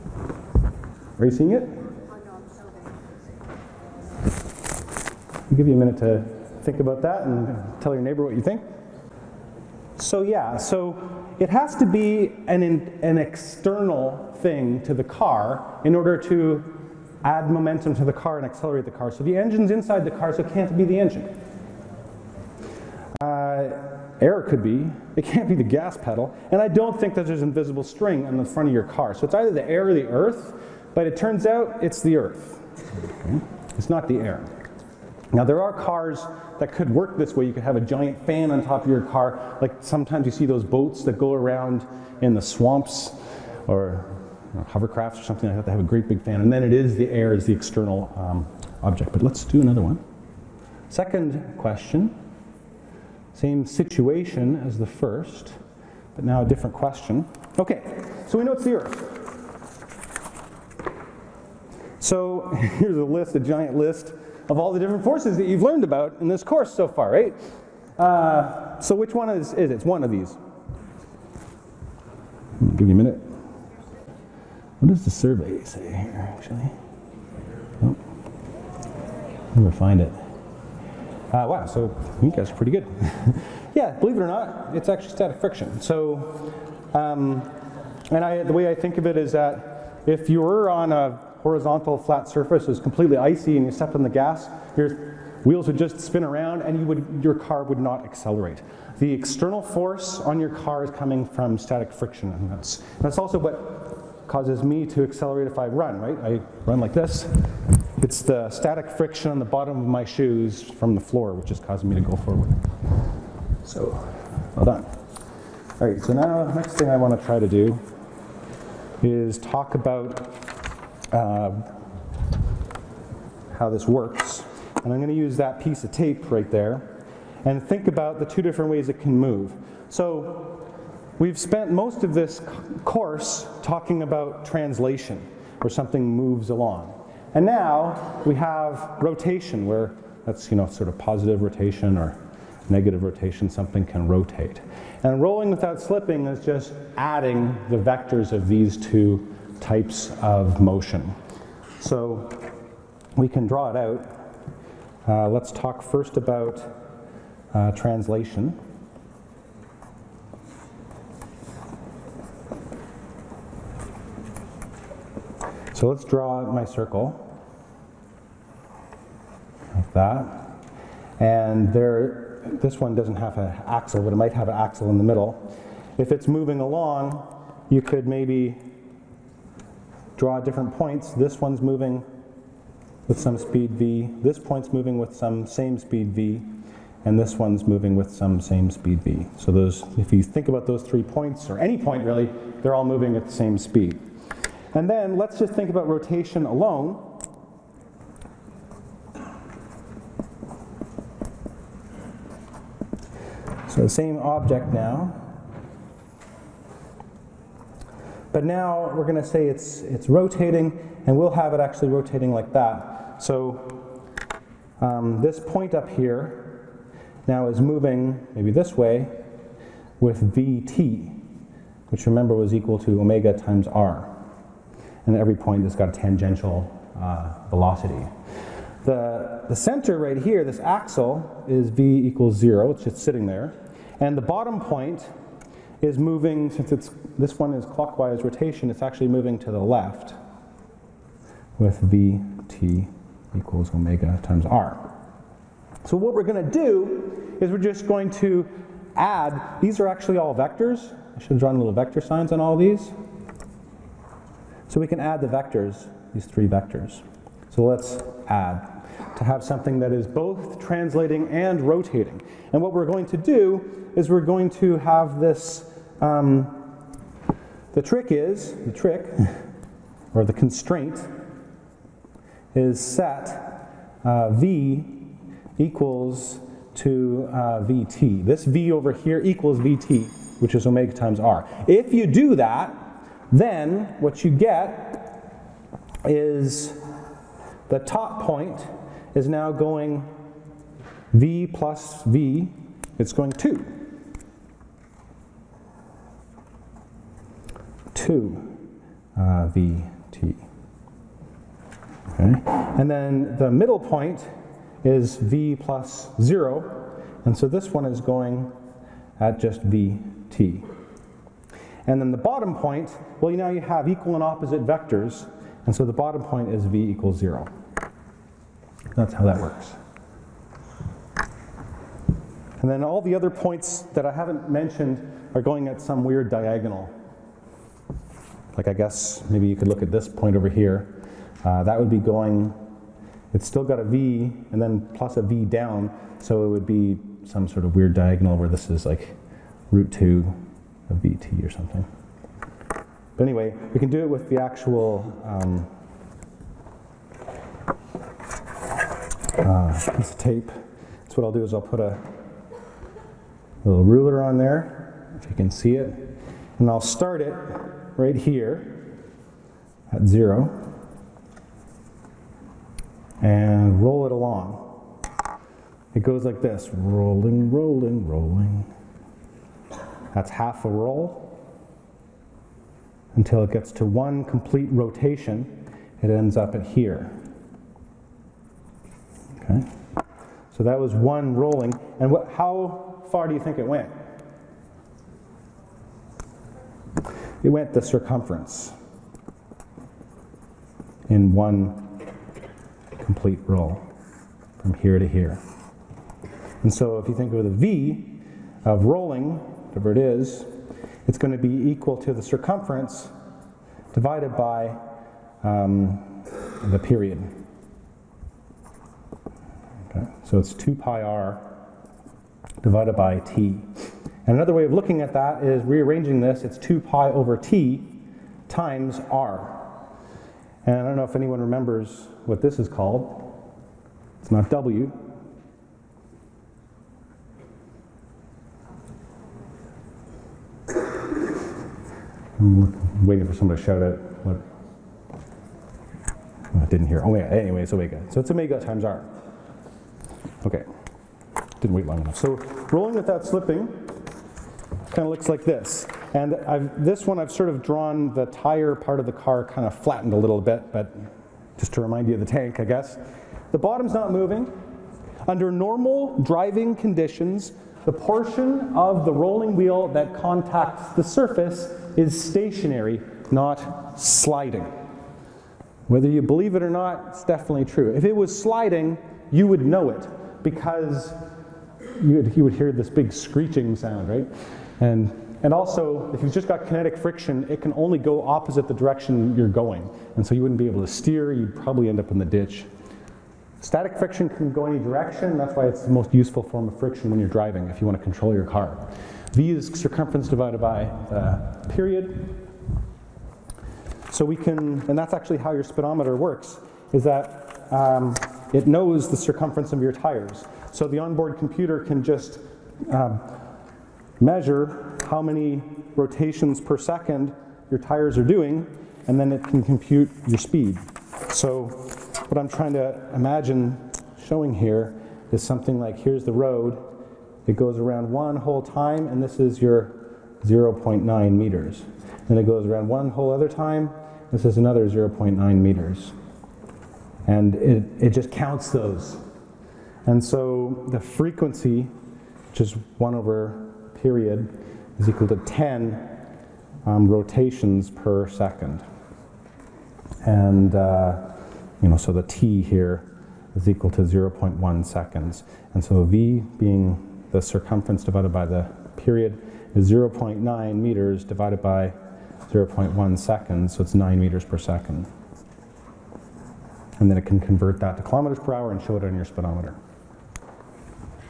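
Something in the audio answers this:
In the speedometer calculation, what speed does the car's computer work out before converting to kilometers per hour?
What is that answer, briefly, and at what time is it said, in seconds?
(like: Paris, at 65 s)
9 meters per second, at 553 s.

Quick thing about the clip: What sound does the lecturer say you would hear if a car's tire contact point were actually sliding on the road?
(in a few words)
screeching sound.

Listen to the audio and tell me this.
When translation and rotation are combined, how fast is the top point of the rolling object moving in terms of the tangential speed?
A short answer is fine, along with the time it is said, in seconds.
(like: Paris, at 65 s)
2vt, at 298 s.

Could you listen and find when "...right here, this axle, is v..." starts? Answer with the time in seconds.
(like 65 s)
229 s.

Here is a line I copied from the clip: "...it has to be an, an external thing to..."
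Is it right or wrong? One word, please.
right.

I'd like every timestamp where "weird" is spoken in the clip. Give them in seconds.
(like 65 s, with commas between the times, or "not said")
326 s, 337 s.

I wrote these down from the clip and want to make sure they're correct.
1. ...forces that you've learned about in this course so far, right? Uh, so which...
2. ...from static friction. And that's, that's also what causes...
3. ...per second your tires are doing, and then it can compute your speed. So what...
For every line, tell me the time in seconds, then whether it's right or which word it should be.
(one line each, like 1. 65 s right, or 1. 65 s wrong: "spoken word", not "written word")
1. 65 s right
2. 101 s right
3. 506 s right.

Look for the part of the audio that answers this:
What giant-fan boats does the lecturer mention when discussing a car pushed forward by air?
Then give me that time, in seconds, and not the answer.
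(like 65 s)
44 s.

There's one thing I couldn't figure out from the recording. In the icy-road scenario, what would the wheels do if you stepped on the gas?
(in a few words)
spin around.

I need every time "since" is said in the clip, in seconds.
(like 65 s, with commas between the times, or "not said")
236 s.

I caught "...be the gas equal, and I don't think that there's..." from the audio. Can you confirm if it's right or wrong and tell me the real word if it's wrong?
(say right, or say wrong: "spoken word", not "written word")
wrong: "pedal", not "equal".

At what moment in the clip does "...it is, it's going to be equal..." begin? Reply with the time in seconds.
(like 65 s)
399 s.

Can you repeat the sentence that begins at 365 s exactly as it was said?
It goes like this, rolling, rolling, rolling.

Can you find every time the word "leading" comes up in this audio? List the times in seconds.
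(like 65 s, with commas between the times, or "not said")
not said.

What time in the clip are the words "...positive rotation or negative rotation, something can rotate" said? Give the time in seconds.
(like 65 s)
140 s.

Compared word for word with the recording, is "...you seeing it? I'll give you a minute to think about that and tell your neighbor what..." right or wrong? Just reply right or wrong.
right.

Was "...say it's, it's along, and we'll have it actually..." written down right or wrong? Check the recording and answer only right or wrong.
wrong.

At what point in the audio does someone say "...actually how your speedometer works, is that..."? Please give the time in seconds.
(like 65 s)
495 s.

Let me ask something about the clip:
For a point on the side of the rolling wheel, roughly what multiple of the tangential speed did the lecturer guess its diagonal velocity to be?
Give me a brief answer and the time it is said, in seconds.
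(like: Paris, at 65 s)
root 2, at 339 s.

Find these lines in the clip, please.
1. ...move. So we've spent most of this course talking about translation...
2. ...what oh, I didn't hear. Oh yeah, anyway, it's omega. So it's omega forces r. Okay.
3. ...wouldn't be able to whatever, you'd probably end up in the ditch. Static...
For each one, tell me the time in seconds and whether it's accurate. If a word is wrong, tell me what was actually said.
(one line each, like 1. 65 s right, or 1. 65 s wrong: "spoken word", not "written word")
1. 129 s right
2. 434 s wrong: "times", not "forces"
3. 480 s wrong: "steer", not "whatever".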